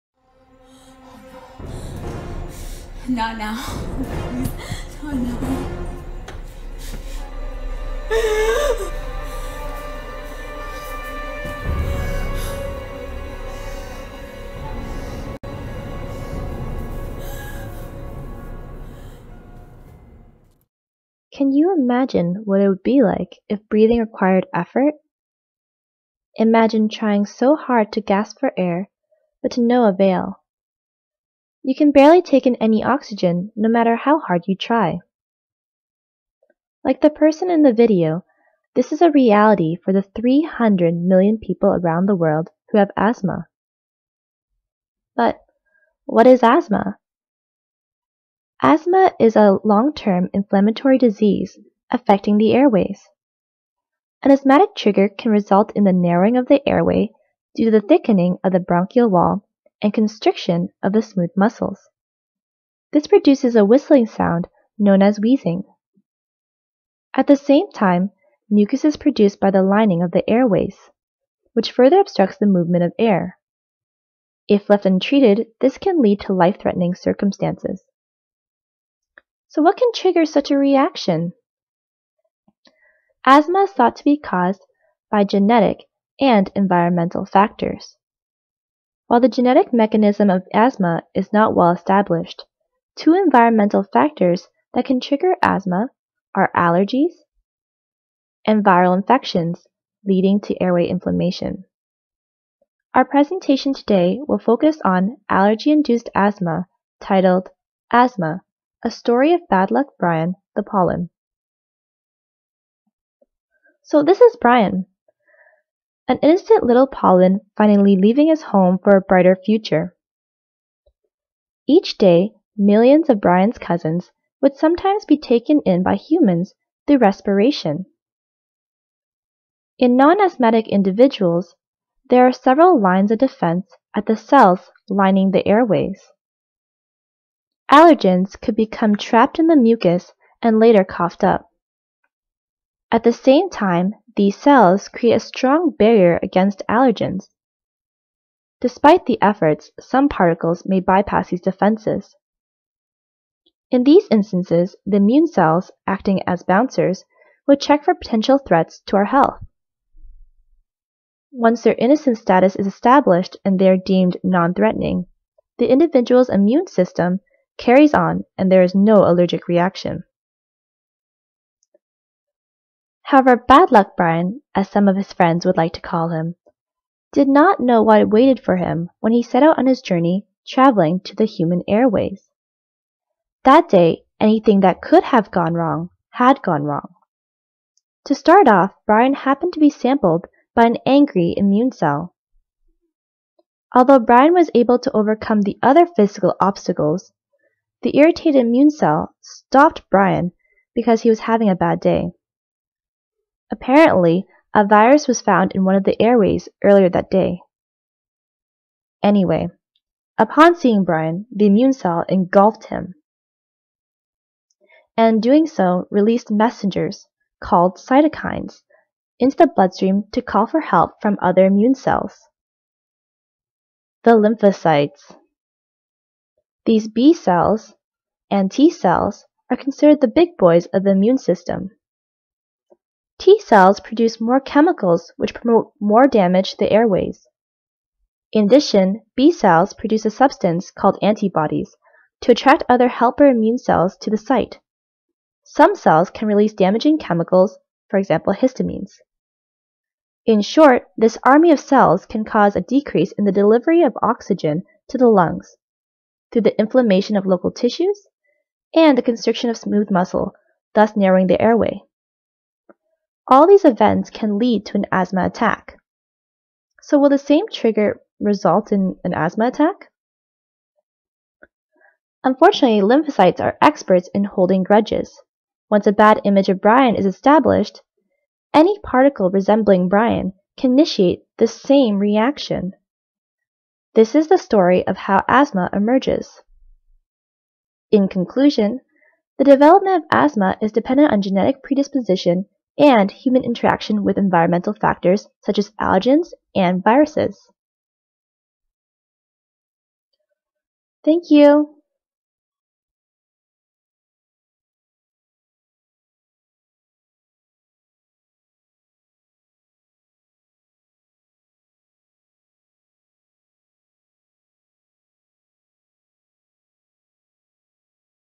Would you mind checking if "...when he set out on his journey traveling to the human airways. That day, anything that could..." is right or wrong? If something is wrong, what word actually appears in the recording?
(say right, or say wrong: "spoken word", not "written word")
right.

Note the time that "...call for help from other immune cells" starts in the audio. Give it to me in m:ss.
3:40.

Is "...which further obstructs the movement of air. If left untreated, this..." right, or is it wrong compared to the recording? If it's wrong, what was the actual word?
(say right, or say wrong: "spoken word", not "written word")
right.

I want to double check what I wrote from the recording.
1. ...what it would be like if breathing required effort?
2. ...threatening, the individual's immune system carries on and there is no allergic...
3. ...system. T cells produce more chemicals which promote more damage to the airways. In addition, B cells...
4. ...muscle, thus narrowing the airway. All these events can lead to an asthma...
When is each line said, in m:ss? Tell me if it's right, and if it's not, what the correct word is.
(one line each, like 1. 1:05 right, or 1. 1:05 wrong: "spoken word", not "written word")
1. 0:22 right
2. 2:44 right
3. 3:51 right
4. 4:19 right.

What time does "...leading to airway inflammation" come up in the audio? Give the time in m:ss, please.
1:40.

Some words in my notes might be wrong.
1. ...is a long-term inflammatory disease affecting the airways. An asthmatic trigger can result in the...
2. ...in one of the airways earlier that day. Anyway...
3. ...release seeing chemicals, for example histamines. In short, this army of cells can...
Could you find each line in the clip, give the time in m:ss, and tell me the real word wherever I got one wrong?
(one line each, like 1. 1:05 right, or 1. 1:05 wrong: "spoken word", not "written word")
1. 0:49 right
2. 3:25 right
3. 4:06 wrong: "damaging", not "seeing".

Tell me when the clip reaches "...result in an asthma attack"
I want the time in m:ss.
4:28.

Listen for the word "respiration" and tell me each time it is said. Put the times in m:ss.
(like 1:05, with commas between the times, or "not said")
2:06.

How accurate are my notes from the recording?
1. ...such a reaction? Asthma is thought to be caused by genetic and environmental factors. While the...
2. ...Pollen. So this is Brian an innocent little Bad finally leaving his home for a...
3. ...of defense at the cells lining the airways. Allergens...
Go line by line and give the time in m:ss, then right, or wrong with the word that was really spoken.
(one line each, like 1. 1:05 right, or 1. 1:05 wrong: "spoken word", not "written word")
1. 1:20 right
2. 1:50 wrong: "Pollen", not "Bad"
3. 2:13 right.